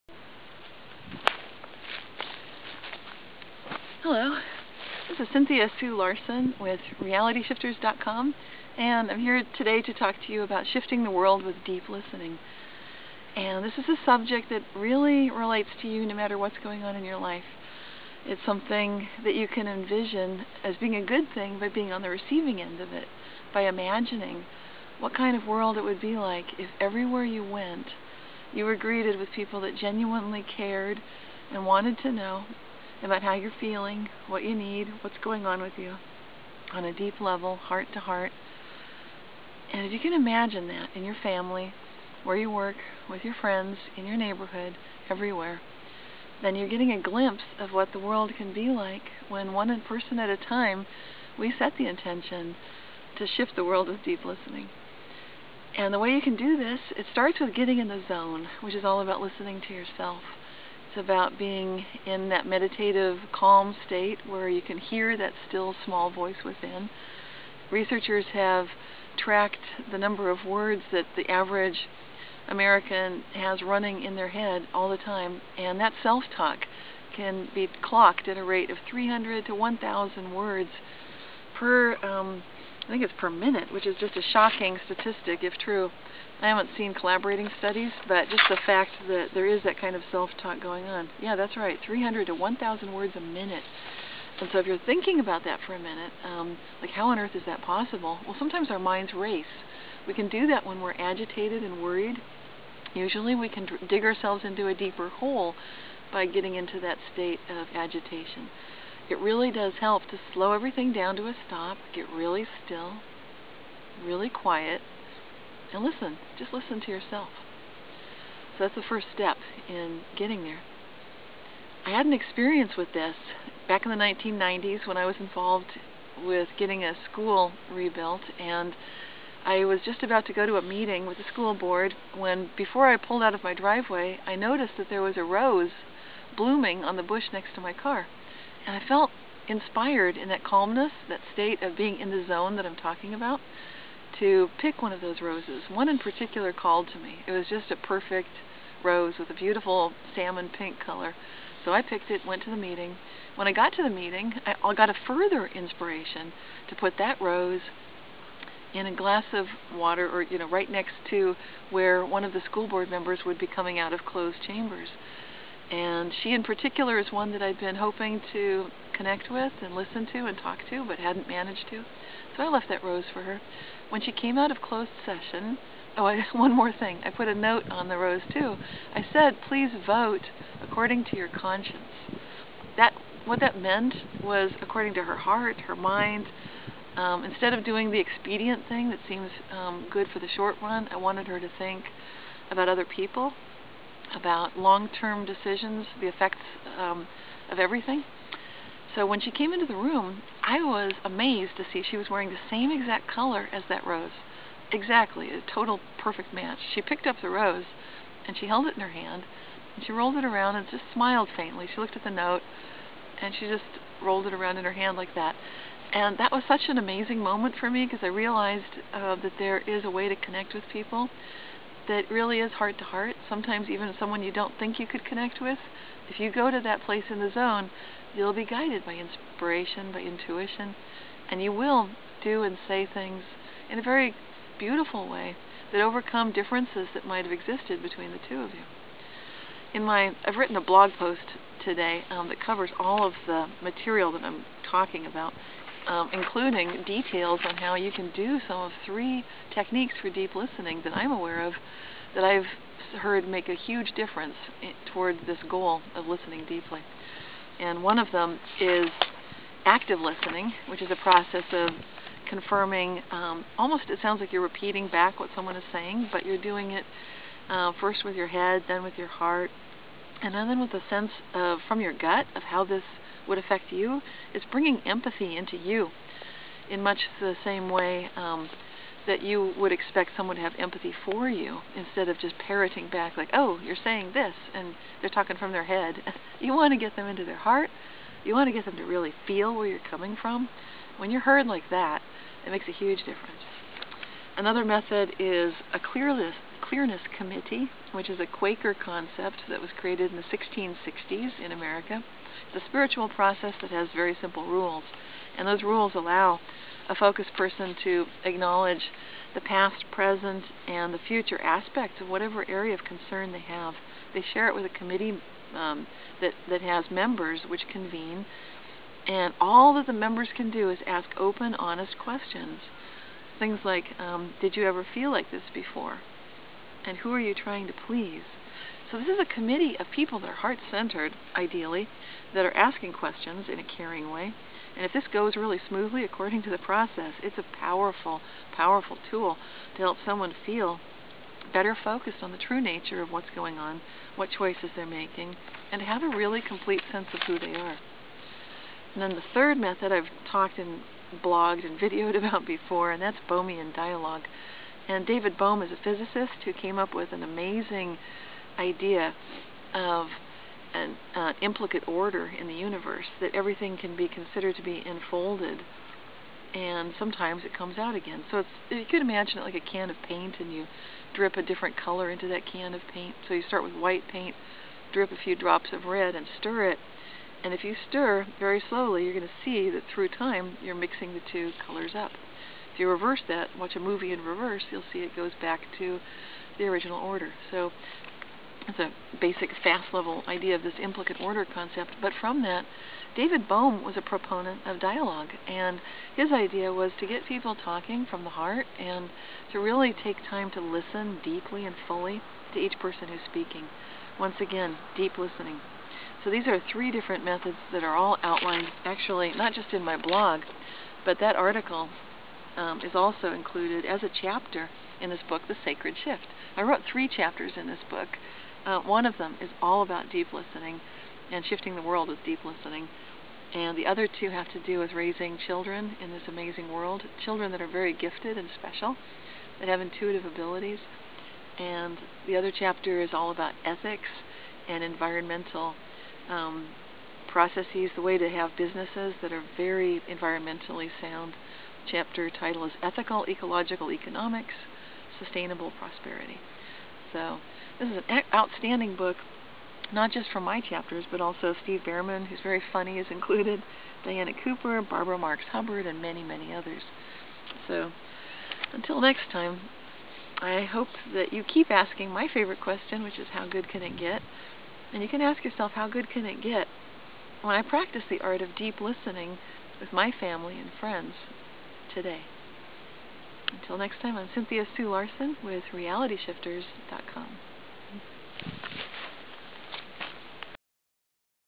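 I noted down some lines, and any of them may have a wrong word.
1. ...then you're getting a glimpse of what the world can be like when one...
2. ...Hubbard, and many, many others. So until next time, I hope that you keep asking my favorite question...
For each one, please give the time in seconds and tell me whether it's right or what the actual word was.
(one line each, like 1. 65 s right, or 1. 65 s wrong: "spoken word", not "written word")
1. 46 s right
2. 455 s right.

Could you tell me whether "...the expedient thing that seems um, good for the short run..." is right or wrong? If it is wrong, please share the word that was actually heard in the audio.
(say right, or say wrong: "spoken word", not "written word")
right.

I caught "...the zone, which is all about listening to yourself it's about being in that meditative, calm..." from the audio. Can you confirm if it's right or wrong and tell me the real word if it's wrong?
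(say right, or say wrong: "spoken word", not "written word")
right.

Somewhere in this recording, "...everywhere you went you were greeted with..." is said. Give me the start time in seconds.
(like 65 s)
26 s.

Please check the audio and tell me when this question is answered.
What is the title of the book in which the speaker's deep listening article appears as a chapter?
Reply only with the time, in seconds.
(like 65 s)
415 s.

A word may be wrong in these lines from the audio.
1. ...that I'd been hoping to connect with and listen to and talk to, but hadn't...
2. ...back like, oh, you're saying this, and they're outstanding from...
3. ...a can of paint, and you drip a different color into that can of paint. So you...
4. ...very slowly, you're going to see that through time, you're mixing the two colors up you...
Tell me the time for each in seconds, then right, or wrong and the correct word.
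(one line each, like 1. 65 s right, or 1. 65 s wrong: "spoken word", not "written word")
1. 167 s right
2. 282 s wrong: "talking", not "outstanding"
3. 369 s right
4. 378 s right.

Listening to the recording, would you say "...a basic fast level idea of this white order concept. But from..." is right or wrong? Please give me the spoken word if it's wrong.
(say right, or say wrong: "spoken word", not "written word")
wrong: "implicate", not "white".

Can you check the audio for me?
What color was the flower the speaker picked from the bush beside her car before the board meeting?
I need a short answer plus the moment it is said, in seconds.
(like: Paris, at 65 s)
Salmon pink, at 150 s.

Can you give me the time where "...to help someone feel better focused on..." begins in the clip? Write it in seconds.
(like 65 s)
339 s.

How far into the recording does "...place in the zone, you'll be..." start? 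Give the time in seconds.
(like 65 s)
226 s.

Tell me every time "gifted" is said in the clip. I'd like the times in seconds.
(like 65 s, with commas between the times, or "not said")
427 s.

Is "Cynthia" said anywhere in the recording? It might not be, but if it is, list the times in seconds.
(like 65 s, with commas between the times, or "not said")
5 s, 474 s.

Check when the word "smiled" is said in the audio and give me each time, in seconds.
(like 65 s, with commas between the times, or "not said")
210 s.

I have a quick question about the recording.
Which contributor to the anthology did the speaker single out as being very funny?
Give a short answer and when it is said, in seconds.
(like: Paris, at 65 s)
Steve Bhaerman, at 451 s.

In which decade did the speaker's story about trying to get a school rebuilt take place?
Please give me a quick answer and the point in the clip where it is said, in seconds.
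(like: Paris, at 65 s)
1990s, at 123 s.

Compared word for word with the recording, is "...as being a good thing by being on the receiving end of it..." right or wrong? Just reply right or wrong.
right.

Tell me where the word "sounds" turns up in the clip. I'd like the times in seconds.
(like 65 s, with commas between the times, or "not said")
264 s, 441 s.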